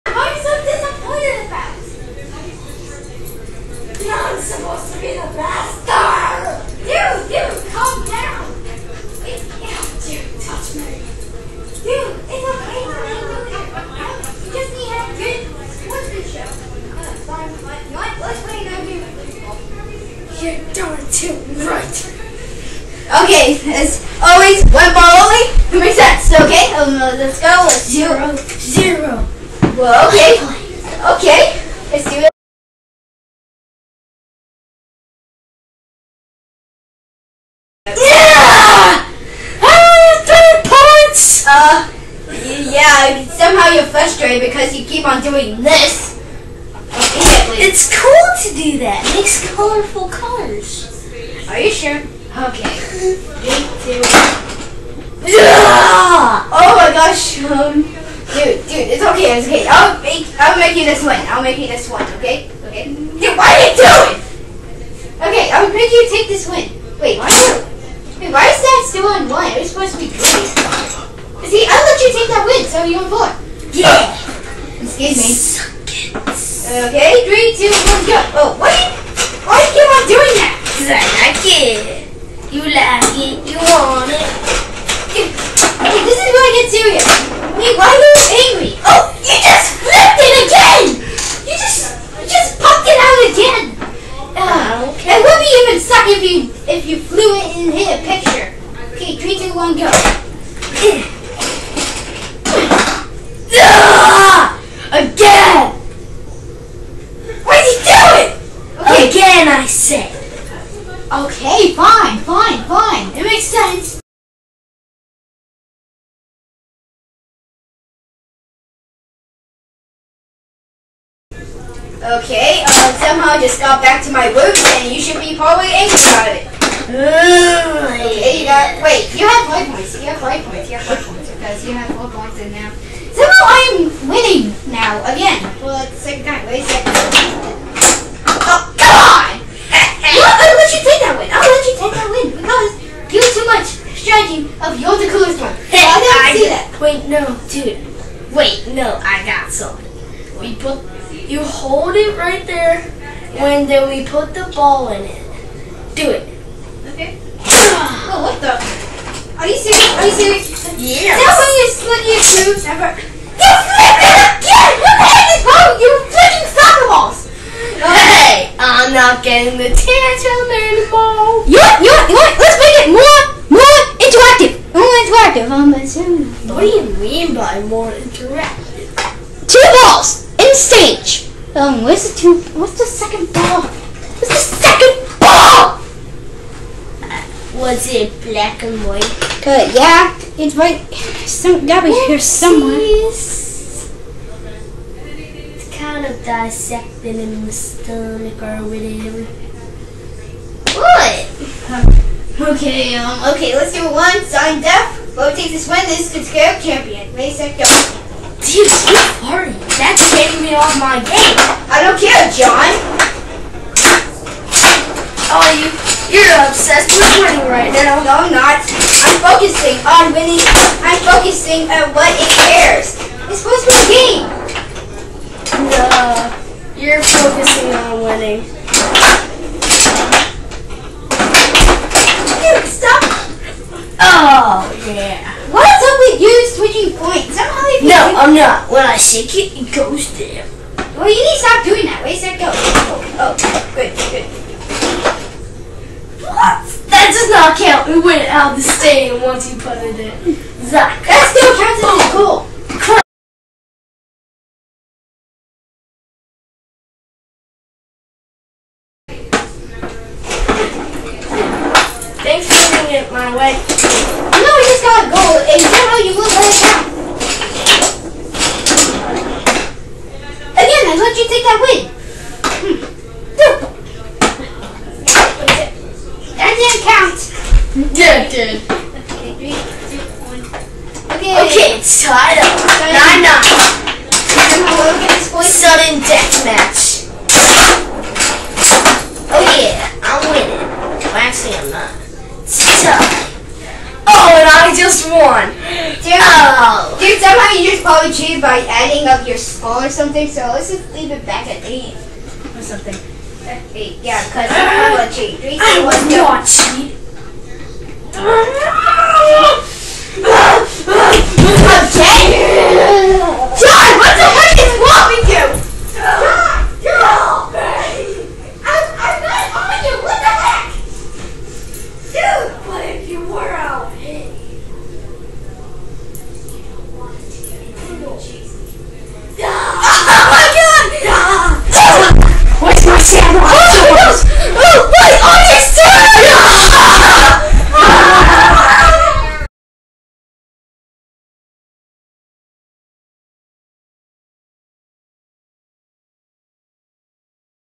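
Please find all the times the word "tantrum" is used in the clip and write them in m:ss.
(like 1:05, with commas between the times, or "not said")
2:49.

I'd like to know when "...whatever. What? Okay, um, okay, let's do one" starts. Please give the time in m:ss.
3:18.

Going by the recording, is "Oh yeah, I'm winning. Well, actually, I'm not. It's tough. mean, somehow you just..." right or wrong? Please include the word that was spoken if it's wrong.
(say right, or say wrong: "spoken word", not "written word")
right.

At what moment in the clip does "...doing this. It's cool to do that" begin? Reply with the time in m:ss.
0:45.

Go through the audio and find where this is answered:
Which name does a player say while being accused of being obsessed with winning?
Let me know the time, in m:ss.
3:32.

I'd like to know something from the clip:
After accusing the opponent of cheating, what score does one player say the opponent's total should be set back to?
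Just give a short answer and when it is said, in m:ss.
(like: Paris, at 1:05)
8, at 5:01.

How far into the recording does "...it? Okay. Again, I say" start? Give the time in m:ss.
1:48.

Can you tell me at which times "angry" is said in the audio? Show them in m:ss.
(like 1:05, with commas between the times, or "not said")
1:28, 2:05.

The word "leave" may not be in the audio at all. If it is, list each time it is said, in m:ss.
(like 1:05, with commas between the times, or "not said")
2:32, 5:00.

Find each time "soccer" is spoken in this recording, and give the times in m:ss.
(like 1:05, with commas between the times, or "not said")
2:46.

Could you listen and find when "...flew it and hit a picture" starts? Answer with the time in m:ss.
1:36.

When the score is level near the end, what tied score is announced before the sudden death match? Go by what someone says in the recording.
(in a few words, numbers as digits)
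9-9.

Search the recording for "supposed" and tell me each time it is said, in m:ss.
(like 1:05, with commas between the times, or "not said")
1:09, 3:43.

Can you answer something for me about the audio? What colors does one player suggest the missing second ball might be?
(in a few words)
Black and white.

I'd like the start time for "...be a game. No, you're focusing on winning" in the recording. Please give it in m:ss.
3:43.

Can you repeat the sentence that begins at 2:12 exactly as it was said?
Somehow I'm winning now, again, for the second time, wait a second.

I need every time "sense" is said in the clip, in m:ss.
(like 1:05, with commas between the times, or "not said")
1:53.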